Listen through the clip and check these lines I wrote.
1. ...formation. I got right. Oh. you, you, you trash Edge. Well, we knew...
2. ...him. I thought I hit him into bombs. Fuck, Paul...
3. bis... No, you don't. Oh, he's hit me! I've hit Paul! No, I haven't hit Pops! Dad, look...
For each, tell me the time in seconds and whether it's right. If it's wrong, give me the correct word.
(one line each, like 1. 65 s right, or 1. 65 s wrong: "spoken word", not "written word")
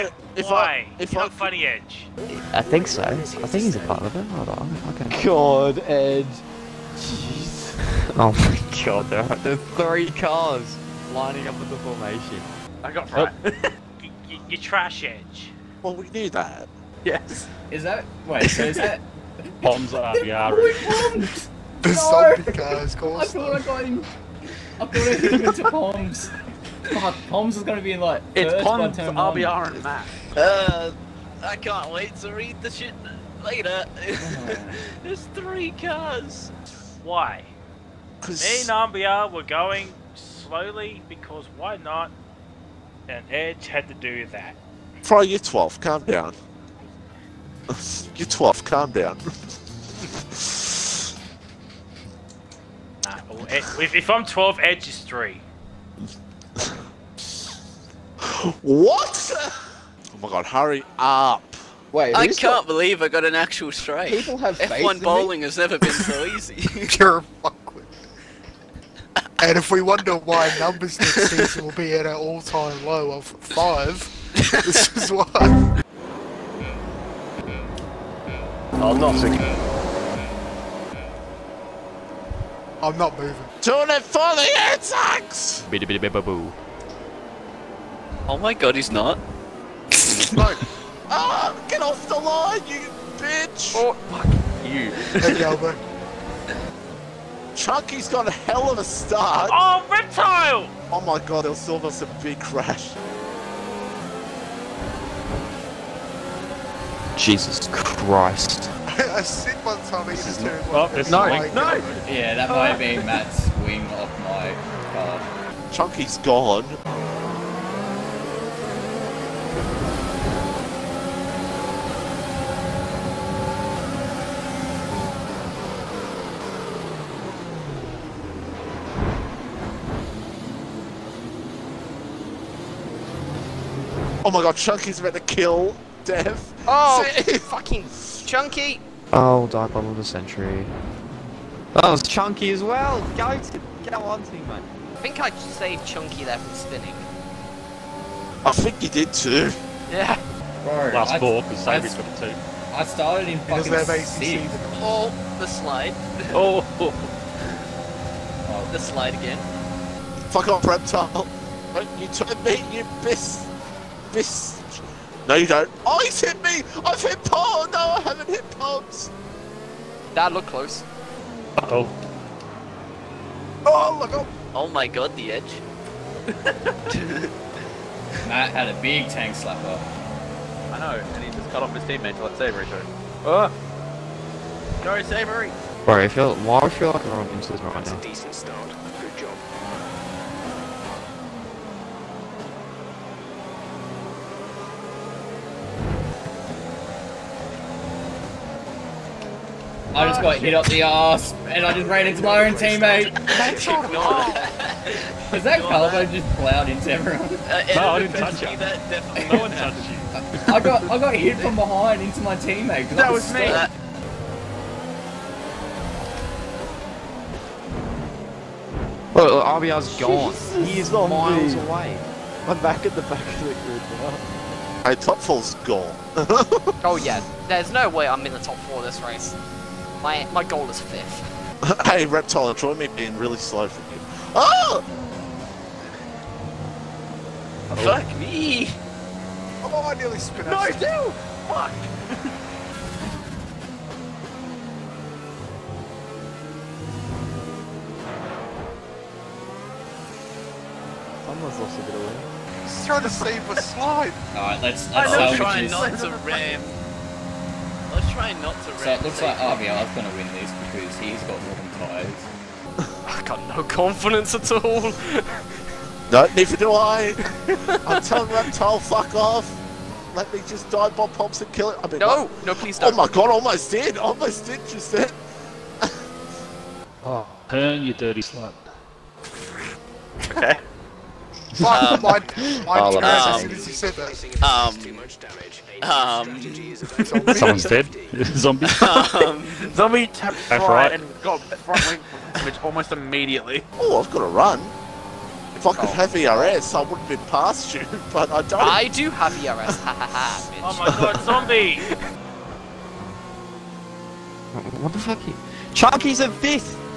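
1. 11 s right
2. 23 s wrong: "Poms", not "Paul"
3. 164 s right.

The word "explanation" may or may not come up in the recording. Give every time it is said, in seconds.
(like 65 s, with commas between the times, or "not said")
not said.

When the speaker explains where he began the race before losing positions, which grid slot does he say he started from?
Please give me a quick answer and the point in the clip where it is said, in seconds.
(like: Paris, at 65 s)
6, at 154 s.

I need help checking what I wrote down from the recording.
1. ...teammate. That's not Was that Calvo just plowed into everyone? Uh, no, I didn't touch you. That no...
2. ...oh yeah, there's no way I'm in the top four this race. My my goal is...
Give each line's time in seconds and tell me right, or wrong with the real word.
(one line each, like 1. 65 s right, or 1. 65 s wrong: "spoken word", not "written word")
1. 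202 s right
2. 226 s right.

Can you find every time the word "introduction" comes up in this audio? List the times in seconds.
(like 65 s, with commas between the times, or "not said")
not said.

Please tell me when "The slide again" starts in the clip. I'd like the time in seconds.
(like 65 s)
158 s.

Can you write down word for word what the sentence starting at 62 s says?
believe I got an actual strike.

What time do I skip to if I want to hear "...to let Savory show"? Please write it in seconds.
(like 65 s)
182 s.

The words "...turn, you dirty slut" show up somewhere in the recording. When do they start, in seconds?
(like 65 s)
277 s.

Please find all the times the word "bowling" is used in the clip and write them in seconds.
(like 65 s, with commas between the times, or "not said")
65 s.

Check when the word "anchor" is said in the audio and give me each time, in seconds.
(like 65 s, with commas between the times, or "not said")
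not said.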